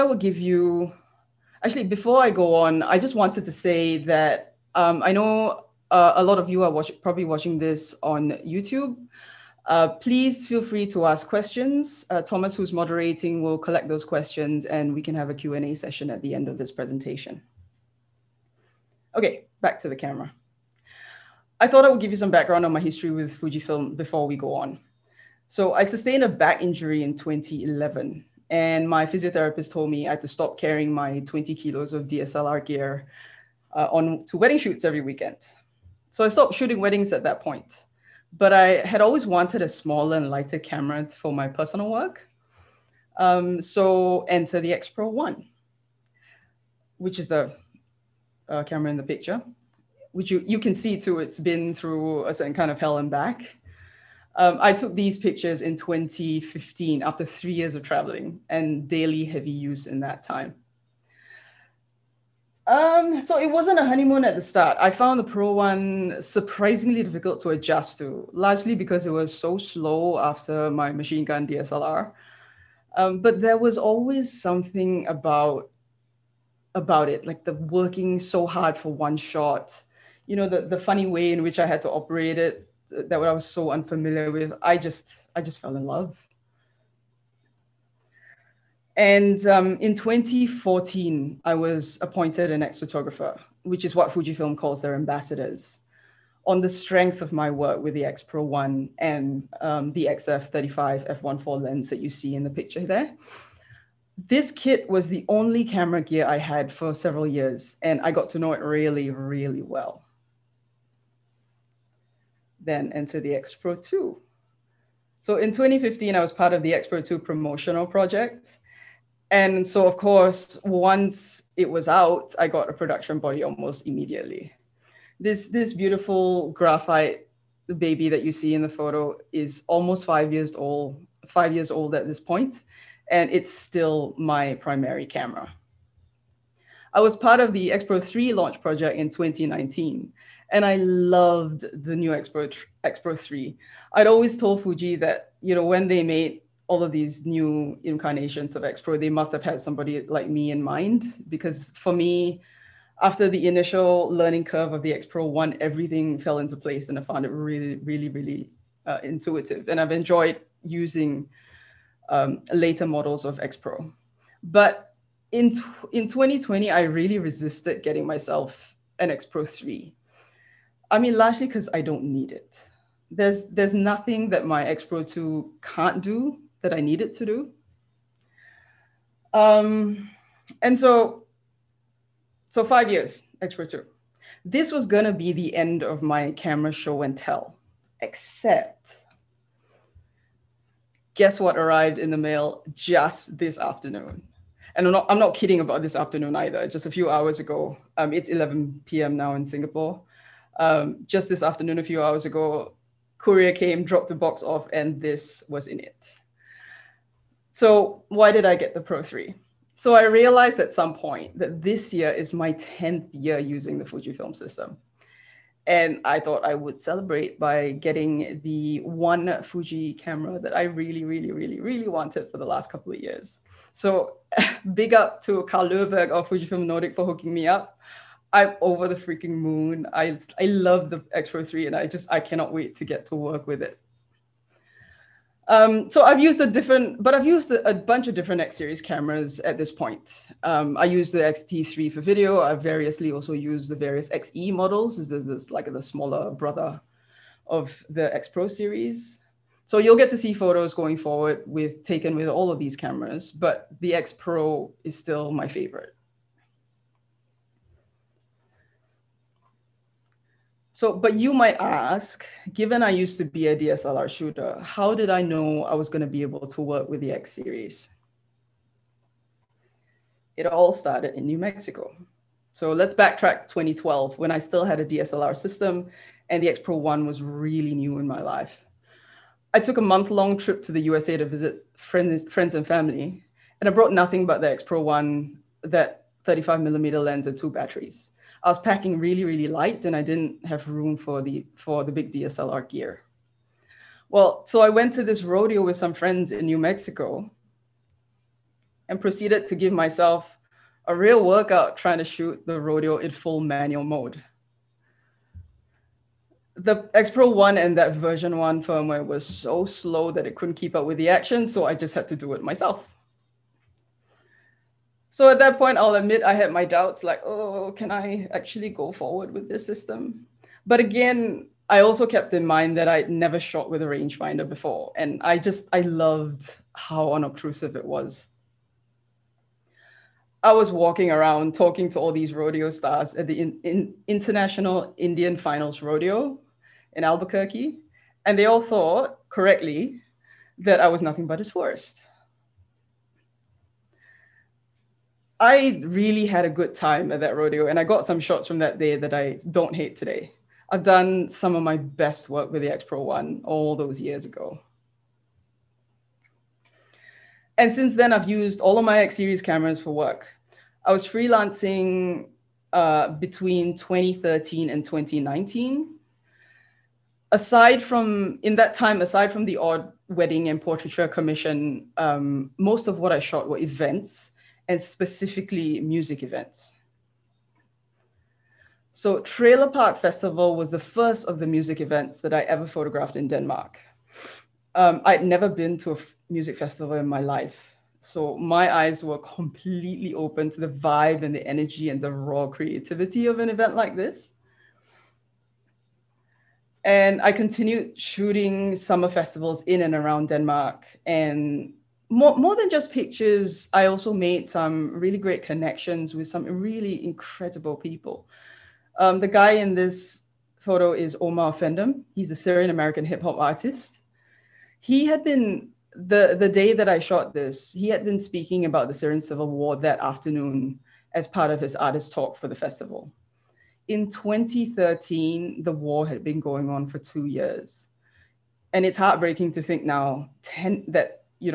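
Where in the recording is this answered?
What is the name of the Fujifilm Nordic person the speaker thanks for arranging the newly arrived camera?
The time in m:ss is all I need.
3:45.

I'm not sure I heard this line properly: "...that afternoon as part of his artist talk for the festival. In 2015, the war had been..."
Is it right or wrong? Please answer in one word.
wrong.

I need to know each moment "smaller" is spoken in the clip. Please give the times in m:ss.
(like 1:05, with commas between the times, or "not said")
0:39, 4:05.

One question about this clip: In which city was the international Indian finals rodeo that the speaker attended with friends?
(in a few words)
Albuquerque.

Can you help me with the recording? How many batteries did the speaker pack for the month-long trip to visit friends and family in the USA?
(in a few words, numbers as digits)
2.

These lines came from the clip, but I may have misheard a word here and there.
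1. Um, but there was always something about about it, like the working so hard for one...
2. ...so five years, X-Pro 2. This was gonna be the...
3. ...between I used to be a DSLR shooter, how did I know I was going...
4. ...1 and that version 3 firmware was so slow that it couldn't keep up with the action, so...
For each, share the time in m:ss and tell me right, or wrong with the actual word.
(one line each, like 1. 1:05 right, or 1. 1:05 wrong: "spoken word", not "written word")
1. 1:12 right
2. 3:02 right
3. 4:22 wrong: "given", not "between"
4. 5:07 wrong: "1", not "3".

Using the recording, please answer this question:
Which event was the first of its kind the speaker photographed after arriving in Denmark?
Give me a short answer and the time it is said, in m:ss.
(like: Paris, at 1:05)
Trailer Park Festival, at 6:19.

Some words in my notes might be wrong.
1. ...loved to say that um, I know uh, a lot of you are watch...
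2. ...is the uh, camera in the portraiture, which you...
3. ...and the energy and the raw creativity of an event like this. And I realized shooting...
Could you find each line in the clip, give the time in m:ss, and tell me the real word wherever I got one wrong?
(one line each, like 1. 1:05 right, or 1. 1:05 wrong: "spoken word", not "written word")
1. 0:03 wrong: "wanted", not "loved"
2. 0:47 wrong: "picture", not "portraiture"
3. 6:31 wrong: "continued", not "realized".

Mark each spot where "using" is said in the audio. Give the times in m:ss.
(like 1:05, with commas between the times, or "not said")
2:40, 3:33.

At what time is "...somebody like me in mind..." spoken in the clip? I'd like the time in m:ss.
2:29.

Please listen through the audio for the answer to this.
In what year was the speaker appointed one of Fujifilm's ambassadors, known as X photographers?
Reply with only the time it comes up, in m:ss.
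1:29.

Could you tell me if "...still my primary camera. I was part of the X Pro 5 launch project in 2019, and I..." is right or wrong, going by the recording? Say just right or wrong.
wrong.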